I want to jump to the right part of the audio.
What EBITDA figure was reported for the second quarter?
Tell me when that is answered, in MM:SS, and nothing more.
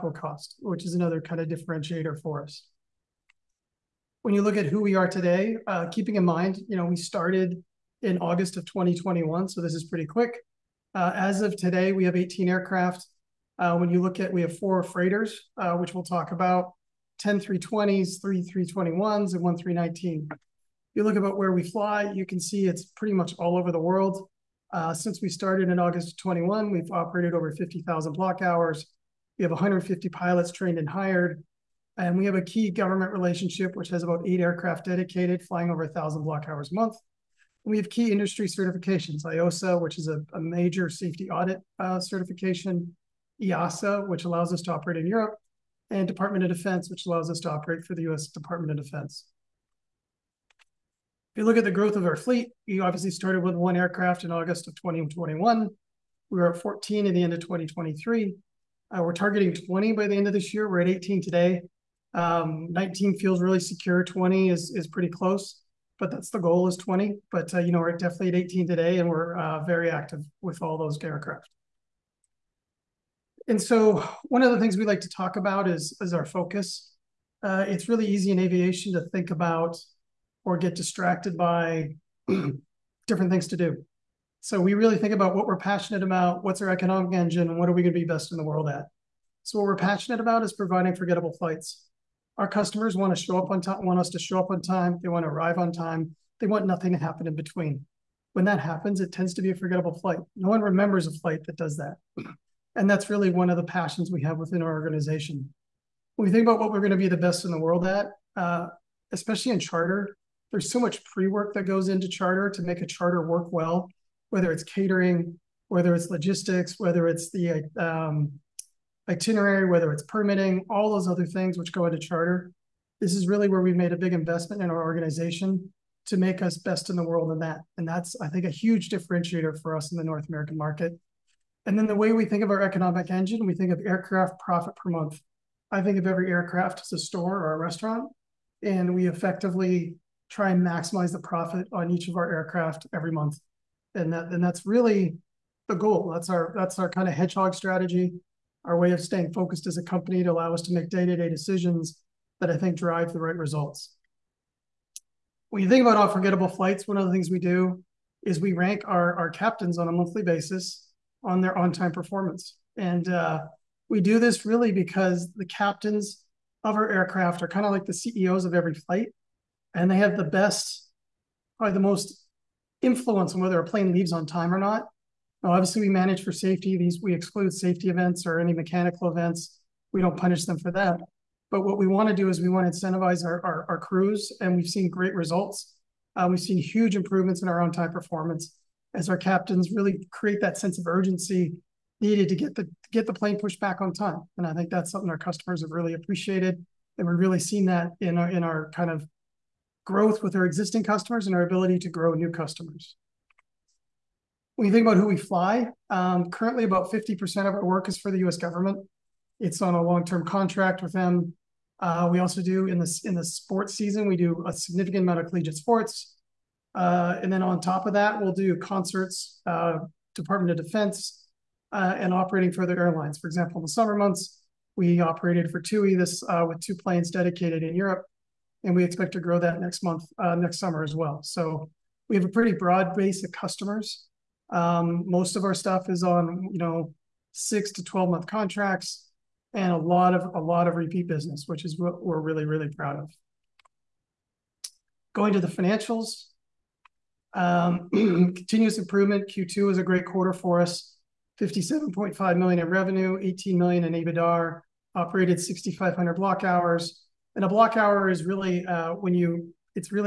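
04:13.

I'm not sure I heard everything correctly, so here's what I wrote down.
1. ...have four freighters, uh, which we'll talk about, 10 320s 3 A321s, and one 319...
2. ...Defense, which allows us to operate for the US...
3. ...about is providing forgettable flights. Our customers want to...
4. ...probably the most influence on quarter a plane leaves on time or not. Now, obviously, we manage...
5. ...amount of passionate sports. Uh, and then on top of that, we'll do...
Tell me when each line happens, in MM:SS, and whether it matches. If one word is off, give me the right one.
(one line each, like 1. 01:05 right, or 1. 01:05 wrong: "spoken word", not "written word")
1. 00:14 right
2. 00:46 right
3. 01:30 right
4. 02:51 wrong: "whether", not "quarter"
5. 03:35 wrong: "collegiate", not "passionate".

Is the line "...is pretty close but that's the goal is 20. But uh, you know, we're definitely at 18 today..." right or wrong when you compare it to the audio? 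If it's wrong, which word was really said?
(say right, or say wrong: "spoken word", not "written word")
right.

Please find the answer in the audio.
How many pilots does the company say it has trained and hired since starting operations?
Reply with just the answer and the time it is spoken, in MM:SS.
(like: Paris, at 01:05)
150, at 00:29.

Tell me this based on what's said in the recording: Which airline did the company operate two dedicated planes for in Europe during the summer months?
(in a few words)
TUI.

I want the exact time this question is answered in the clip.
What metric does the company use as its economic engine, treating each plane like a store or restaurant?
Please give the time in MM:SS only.
02:13.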